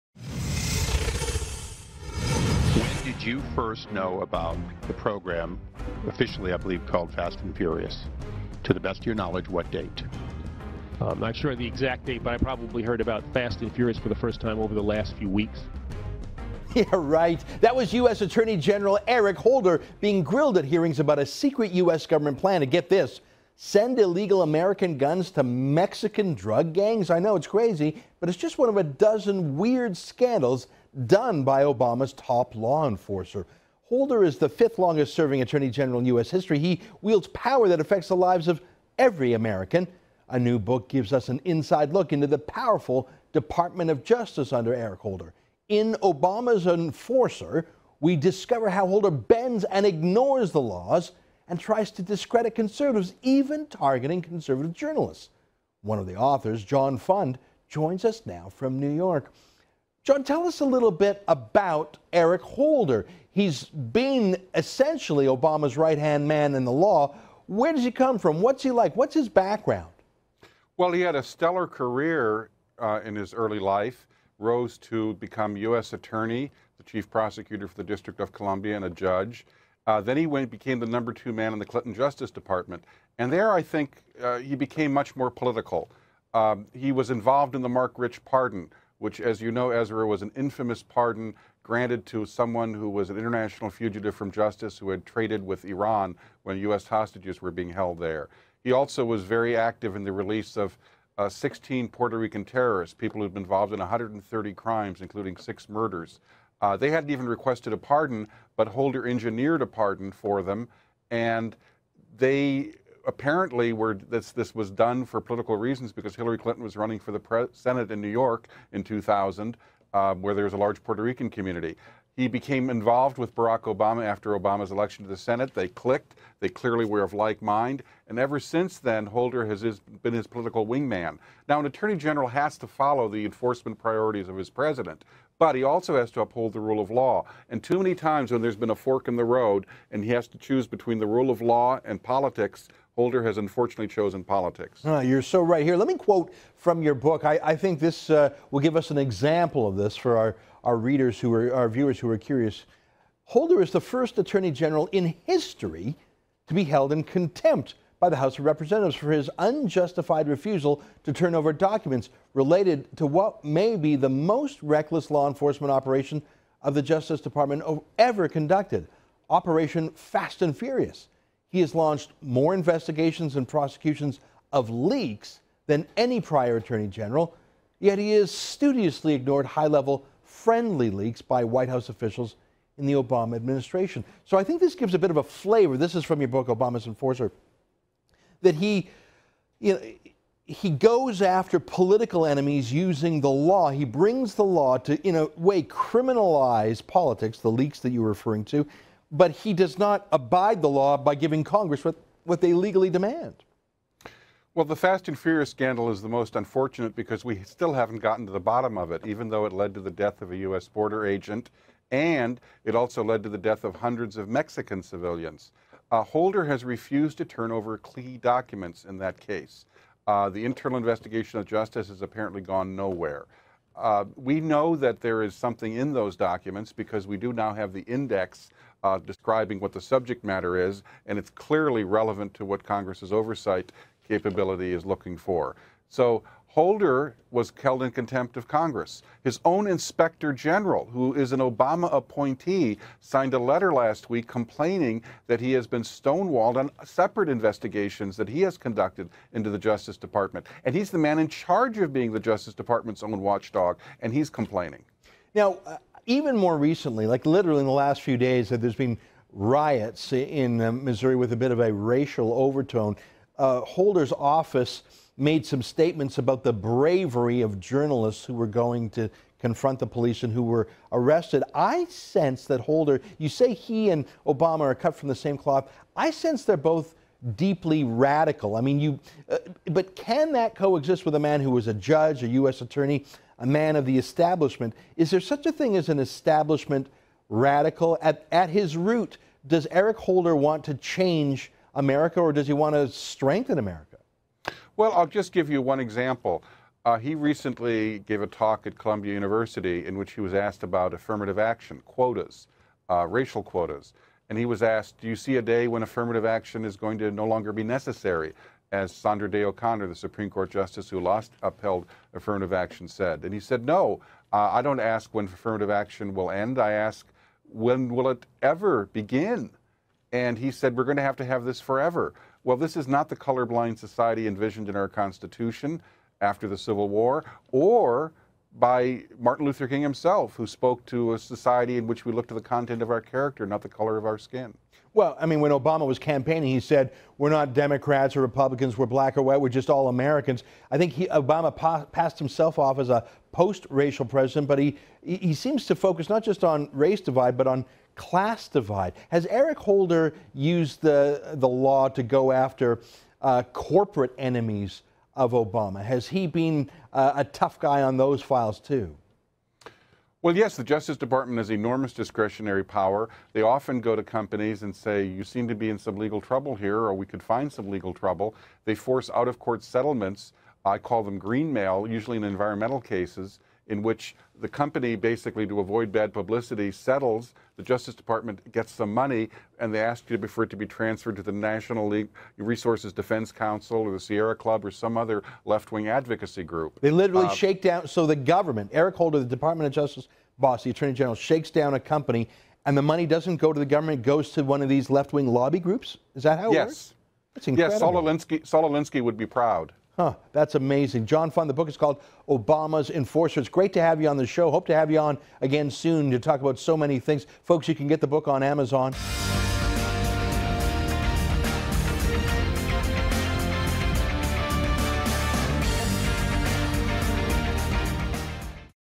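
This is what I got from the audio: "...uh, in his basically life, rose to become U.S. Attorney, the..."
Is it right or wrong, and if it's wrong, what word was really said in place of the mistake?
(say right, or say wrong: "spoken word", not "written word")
wrong: "early", not "basically".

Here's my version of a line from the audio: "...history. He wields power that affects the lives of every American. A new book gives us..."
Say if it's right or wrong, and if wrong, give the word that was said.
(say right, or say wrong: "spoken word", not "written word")
right.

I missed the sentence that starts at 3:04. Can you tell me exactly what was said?
So I think this gives a bit of a flavor.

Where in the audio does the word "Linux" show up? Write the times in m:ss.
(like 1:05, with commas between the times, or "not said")
not said.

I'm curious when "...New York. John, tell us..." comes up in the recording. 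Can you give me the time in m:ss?
0:58.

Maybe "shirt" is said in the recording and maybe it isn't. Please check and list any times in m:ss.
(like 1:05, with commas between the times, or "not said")
not said.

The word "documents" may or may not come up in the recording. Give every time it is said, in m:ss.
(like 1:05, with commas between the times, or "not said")
2:41, 3:38, 3:46.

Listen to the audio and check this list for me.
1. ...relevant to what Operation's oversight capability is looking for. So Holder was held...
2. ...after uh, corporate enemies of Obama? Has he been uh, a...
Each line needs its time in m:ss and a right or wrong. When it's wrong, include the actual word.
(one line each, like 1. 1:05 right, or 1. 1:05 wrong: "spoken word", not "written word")
1. 3:51 wrong: "Congress", not "Operation"
2. 5:52 right.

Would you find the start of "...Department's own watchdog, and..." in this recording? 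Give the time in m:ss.
4:12.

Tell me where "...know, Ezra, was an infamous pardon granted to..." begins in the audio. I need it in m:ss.
1:29.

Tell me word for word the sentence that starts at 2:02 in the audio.
He became involved with Barack Obama after Obama's election to the Senate.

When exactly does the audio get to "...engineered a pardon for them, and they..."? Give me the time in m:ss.
1:49.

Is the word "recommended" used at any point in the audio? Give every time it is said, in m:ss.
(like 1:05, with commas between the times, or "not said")
not said.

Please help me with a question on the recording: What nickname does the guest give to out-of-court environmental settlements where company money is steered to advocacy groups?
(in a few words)
green mail.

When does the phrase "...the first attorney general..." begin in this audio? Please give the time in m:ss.
2:33.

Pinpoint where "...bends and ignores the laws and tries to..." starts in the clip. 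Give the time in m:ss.
0:49.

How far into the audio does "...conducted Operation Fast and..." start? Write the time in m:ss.
2:48.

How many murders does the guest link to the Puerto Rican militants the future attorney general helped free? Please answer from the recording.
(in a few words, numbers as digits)
6.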